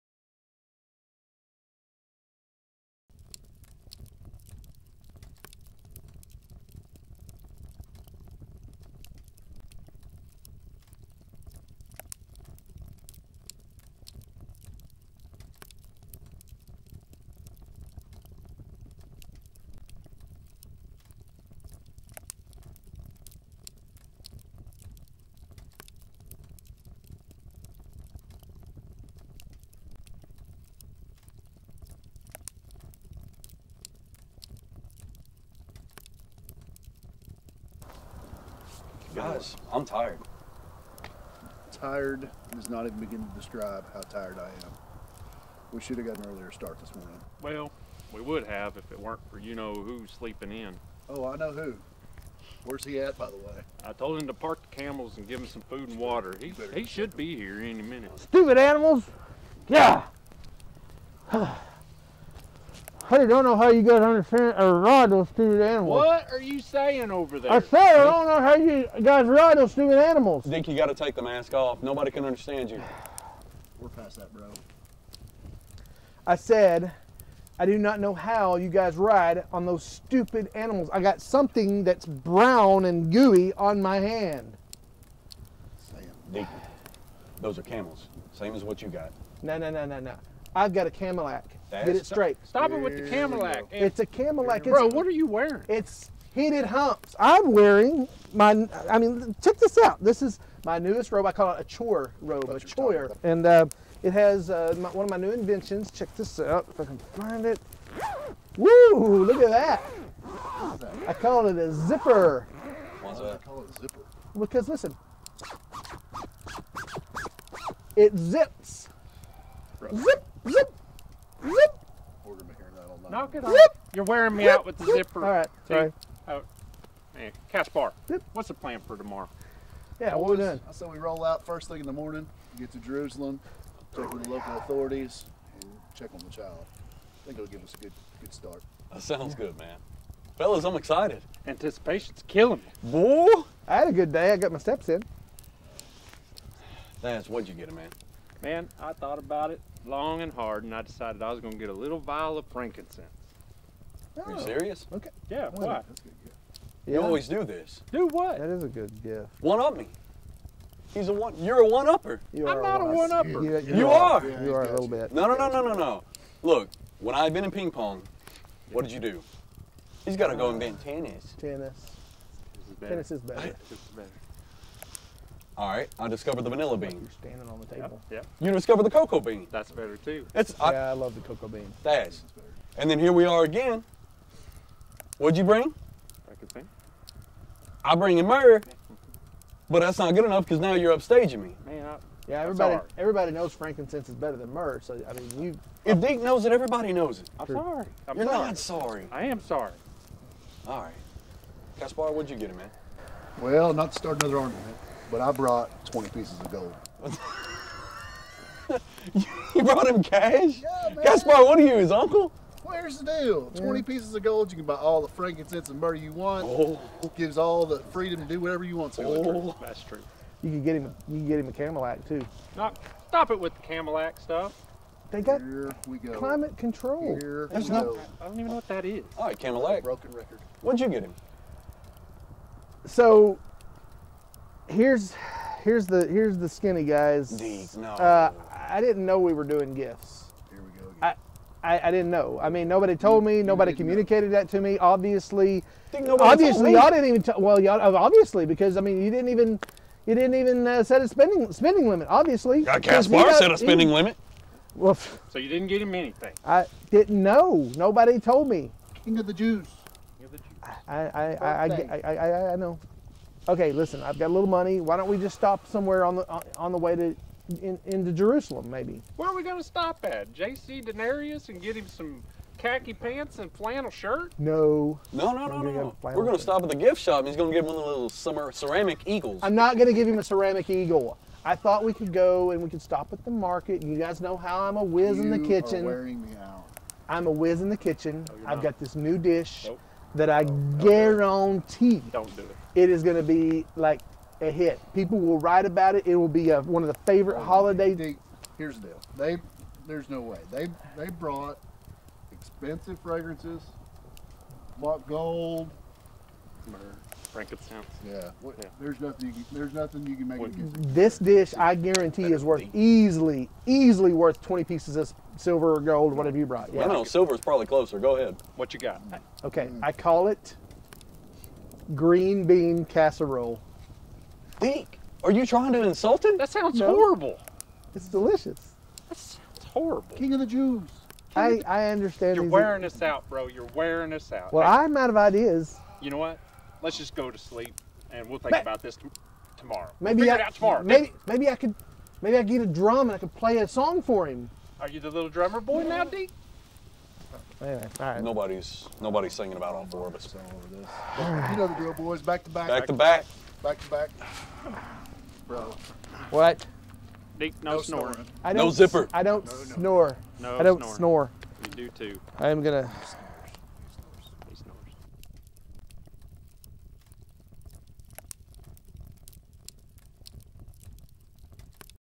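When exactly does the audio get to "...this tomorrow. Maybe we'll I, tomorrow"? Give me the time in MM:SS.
05:38.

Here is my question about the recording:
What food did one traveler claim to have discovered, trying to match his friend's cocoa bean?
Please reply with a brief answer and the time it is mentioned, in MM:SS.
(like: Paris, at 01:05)
Vanilla bean, at 02:56.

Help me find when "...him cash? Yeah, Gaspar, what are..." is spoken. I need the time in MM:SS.
03:29.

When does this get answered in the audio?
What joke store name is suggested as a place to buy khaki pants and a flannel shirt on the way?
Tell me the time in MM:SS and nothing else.
04:30.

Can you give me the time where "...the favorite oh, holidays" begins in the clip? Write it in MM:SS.
04:56.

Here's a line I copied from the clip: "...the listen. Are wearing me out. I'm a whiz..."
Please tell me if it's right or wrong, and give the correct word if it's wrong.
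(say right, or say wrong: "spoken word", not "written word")
wrong: "kitchen", not "listen".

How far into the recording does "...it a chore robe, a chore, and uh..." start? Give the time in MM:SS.
01:41.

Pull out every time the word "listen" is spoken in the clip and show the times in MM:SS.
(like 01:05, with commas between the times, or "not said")
01:54, 04:23.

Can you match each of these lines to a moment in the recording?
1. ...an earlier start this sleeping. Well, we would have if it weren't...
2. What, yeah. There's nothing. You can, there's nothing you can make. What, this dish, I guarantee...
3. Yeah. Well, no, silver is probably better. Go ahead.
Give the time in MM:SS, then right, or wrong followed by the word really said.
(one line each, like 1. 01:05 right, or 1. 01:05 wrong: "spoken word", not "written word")
1. 00:46 wrong: "morning", not "sleeping"
2. 05:08 right
3. 05:16 wrong: "closer", not "better".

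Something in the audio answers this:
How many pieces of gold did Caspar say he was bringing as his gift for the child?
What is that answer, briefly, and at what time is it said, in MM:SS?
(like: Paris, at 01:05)
20, at 03:25.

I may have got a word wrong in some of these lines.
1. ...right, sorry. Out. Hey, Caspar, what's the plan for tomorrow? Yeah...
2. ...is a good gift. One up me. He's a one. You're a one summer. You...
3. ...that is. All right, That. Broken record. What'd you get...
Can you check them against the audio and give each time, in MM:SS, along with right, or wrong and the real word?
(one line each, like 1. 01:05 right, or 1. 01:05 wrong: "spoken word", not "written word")
1. 02:05 right
2. 02:38 wrong: "upper", not "summer"
3. 03:48 wrong: "Camelac", not "That".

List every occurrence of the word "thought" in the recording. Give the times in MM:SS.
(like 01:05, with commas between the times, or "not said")
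02:28, 04:41.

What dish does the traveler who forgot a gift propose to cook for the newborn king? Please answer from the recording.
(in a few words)
Green bean casserole.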